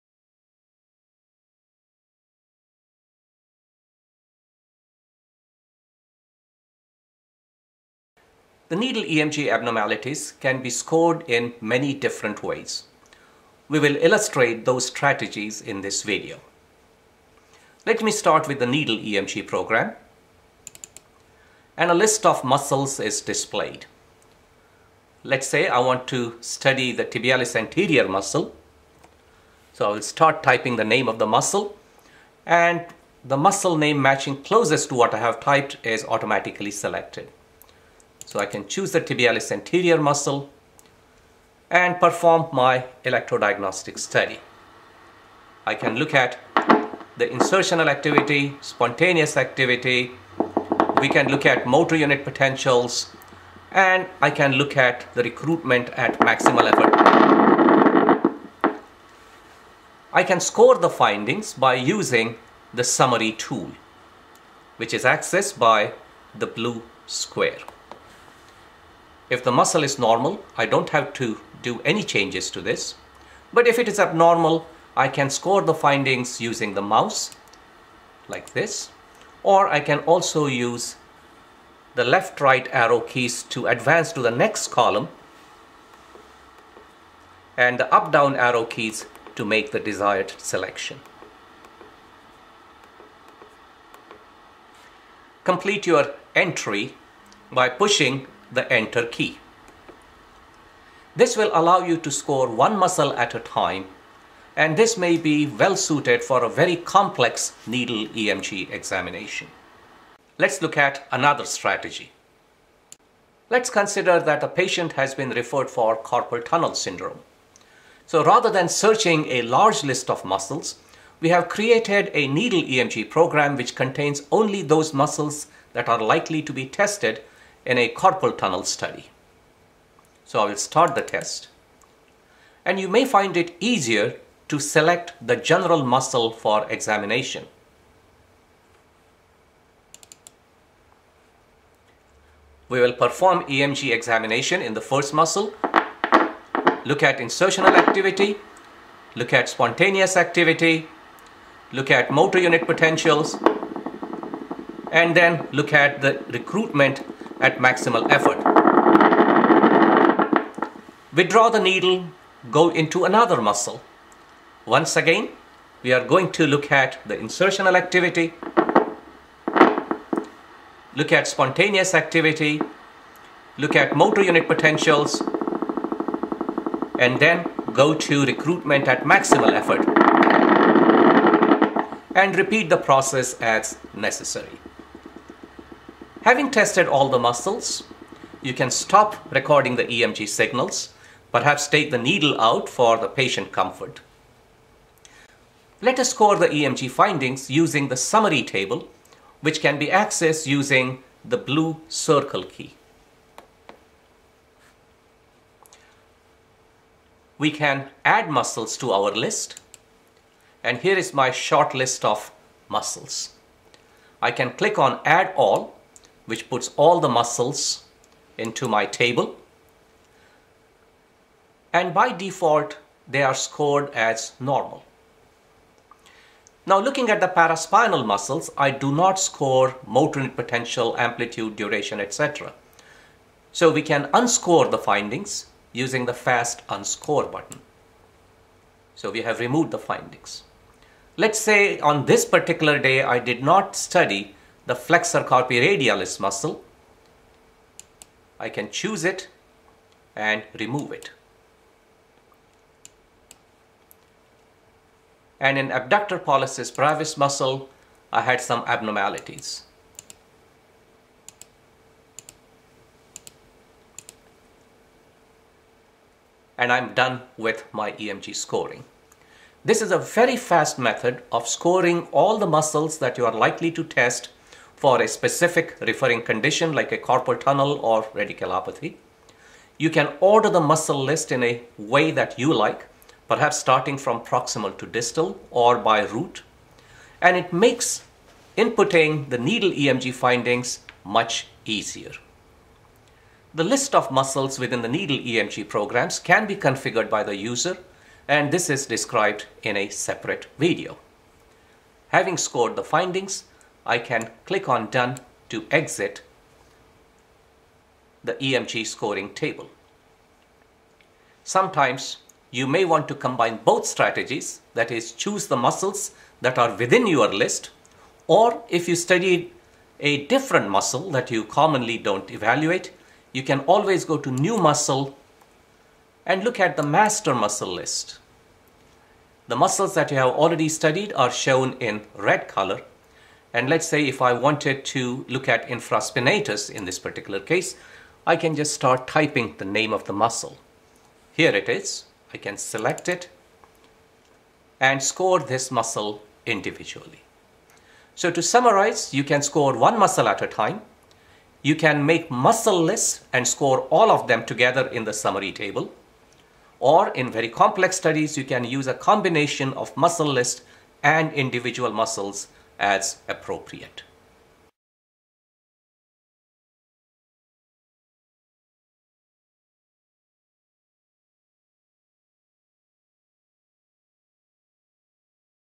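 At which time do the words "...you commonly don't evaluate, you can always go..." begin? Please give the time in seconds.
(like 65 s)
321 s.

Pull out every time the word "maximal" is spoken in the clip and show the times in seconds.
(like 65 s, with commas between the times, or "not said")
56 s, 157 s, 179 s.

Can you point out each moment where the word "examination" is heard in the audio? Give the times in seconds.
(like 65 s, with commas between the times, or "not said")
108 s, 136 s, 143 s.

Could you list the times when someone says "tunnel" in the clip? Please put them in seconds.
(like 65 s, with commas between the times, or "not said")
116 s, 128 s, 277 s.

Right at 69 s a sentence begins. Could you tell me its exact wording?
If the muscle is normal, I don't have to do any changes to this.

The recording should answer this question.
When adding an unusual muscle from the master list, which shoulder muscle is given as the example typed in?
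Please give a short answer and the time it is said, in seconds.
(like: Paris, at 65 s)
Infraspinatus, at 335 s.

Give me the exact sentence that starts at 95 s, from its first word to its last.
Complete your entry by pushing the enter key.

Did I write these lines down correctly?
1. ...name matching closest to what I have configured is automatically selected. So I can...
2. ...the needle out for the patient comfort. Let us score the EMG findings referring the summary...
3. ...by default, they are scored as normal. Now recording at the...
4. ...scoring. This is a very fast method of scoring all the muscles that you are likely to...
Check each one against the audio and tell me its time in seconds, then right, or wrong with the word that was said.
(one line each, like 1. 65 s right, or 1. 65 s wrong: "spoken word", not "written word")
1. 33 s wrong: "typed", not "configured"
2. 191 s wrong: "using", not "referring"
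3. 221 s wrong: "looking", not "recording"
4. 268 s right.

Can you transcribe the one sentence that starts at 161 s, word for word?
Withdraw the needle, go into another muscle.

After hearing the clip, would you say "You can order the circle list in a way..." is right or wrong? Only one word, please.
wrong.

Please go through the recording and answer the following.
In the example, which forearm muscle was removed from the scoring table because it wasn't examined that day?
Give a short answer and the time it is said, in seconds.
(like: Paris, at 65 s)
Flexor carpi radialis, at 244 s.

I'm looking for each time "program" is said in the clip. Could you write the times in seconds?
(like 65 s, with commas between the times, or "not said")
19 s, 123 s, 295 s.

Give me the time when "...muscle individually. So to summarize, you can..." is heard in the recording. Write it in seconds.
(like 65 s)
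345 s.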